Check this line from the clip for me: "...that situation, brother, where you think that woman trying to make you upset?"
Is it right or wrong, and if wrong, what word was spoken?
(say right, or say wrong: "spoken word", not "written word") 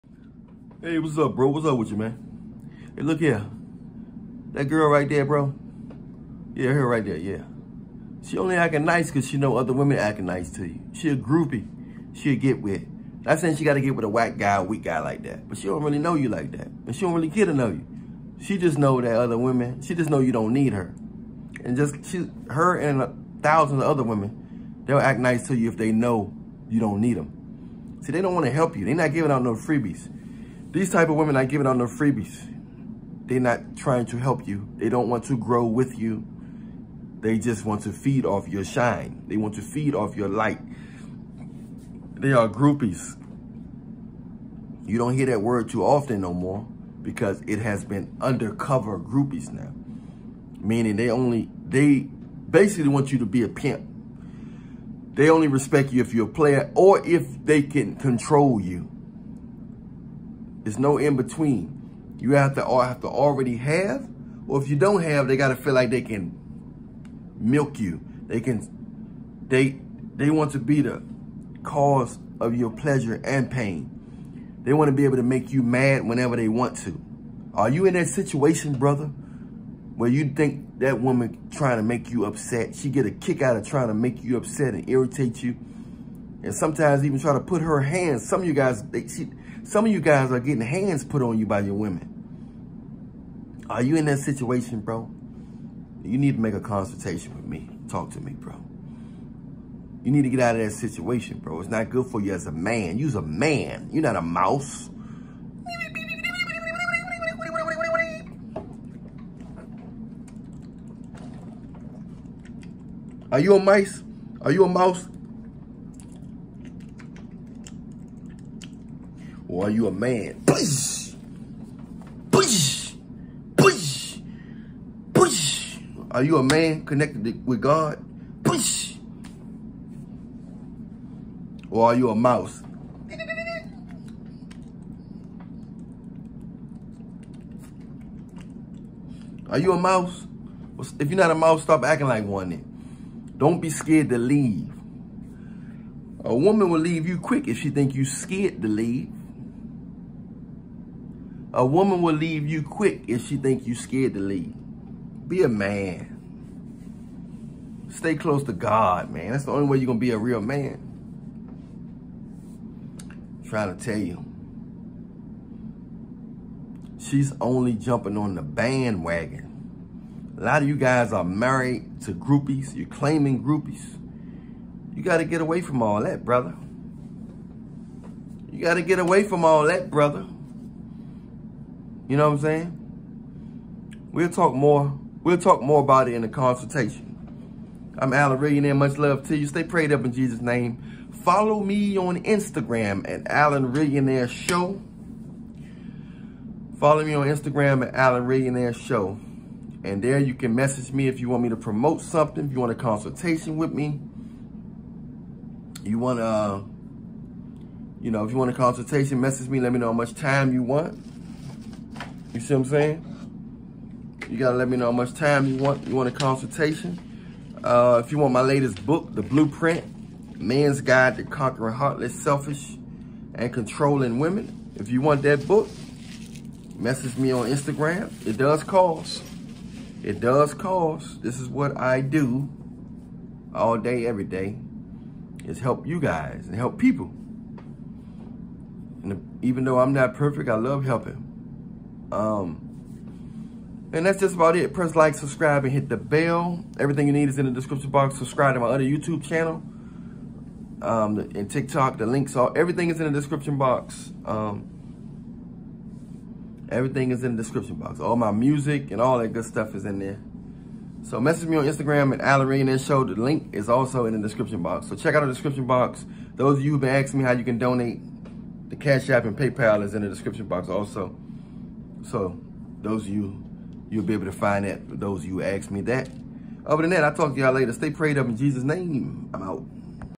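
right.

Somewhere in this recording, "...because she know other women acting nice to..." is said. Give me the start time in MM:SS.
00:09.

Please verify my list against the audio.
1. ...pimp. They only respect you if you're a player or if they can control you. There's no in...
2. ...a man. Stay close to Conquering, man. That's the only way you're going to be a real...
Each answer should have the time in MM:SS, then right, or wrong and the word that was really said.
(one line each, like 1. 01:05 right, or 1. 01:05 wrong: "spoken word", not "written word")
1. 00:53 right
2. 02:35 wrong: "God", not "Conquering".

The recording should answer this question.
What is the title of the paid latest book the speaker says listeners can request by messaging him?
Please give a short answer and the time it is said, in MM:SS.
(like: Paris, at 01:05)
The Blueprint, at 03:39.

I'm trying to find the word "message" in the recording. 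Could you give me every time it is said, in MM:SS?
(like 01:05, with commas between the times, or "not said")
03:20, 03:29, 03:46, 04:21.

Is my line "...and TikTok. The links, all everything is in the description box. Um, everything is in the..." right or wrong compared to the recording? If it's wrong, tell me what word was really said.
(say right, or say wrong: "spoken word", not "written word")
right.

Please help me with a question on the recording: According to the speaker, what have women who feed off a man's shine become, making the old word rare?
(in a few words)
undercover groupies.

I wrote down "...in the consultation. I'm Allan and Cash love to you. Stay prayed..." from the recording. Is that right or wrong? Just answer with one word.
wrong.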